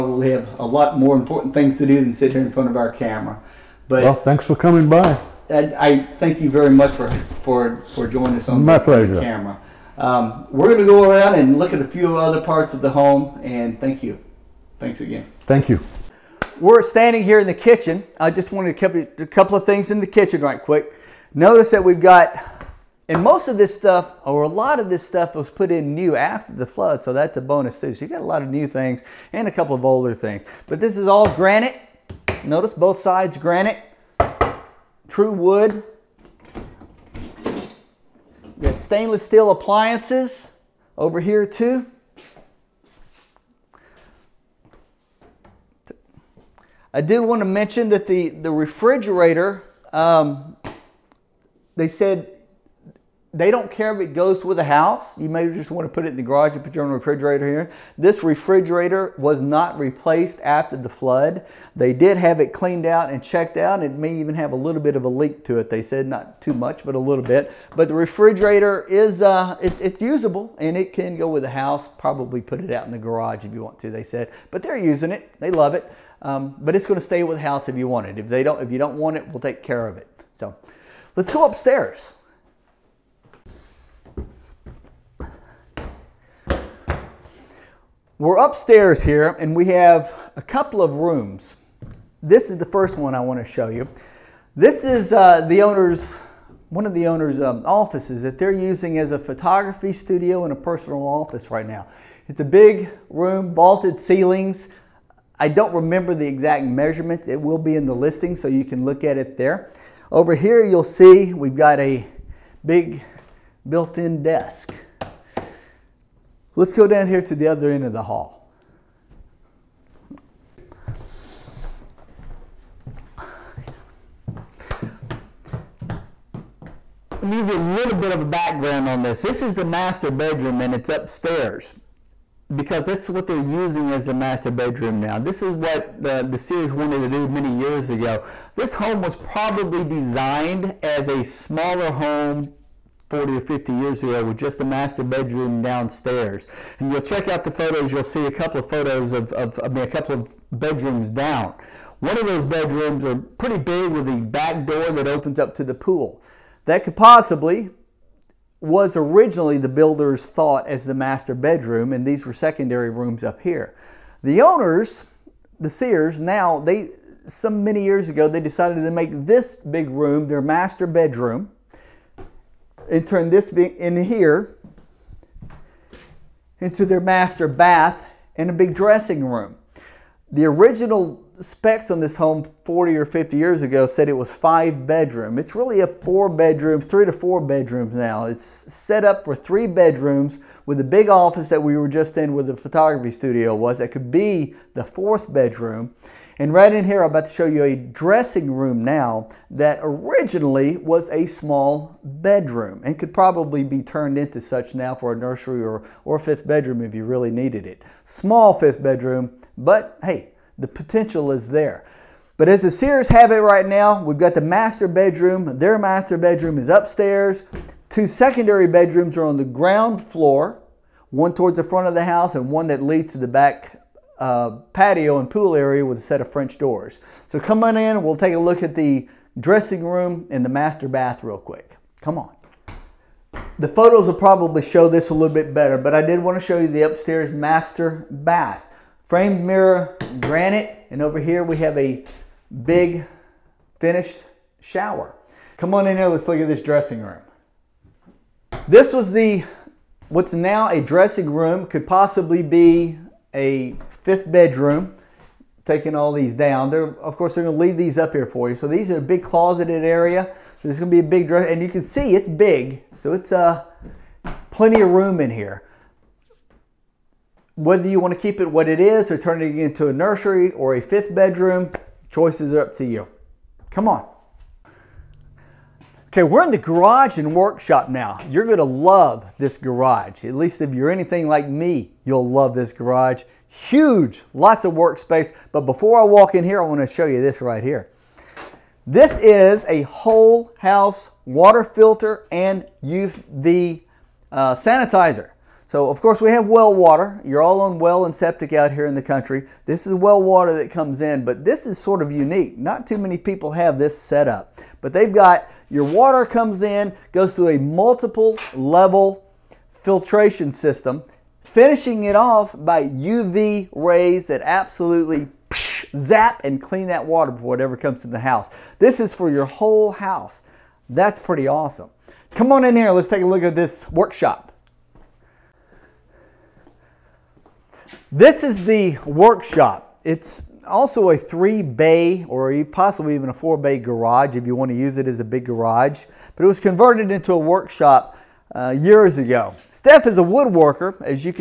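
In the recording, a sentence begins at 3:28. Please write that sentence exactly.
Small fifth bedroom, but hey, the potential is there.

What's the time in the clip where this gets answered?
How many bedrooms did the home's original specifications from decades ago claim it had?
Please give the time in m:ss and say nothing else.
3:04.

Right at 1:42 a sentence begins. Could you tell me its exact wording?
It's a big room, vaulted ceilings.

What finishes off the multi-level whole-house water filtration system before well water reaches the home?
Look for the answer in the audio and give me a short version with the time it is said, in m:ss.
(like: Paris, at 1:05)
UV rays, at 5:12.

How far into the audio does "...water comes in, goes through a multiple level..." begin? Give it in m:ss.
5:05.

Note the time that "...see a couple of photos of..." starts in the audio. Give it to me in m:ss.
2:28.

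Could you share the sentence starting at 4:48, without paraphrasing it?
This is a whole house water filter and UV uh, sanitizer.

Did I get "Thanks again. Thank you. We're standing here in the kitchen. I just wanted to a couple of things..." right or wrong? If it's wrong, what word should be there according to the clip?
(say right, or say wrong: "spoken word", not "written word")
right.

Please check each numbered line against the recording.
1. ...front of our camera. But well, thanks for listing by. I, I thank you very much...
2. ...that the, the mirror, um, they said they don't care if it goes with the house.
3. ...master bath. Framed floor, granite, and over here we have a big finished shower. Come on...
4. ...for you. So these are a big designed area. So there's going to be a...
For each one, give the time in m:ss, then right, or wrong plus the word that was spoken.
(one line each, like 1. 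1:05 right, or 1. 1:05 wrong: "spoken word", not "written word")
1. 0:02 wrong: "coming", not "listing"
2. 0:47 wrong: "refrigerator", not "mirror"
3. 3:57 wrong: "mirror", not "floor"
4. 4:18 wrong: "closeted", not "designed".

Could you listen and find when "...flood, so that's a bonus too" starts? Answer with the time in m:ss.
0:26.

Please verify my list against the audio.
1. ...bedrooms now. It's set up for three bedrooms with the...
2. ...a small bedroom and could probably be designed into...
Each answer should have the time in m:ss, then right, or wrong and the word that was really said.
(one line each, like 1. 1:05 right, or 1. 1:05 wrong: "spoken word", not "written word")
1. 3:07 right
2. 3:21 wrong: "turned", not "designed".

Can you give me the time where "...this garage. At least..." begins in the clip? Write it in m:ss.
4:39.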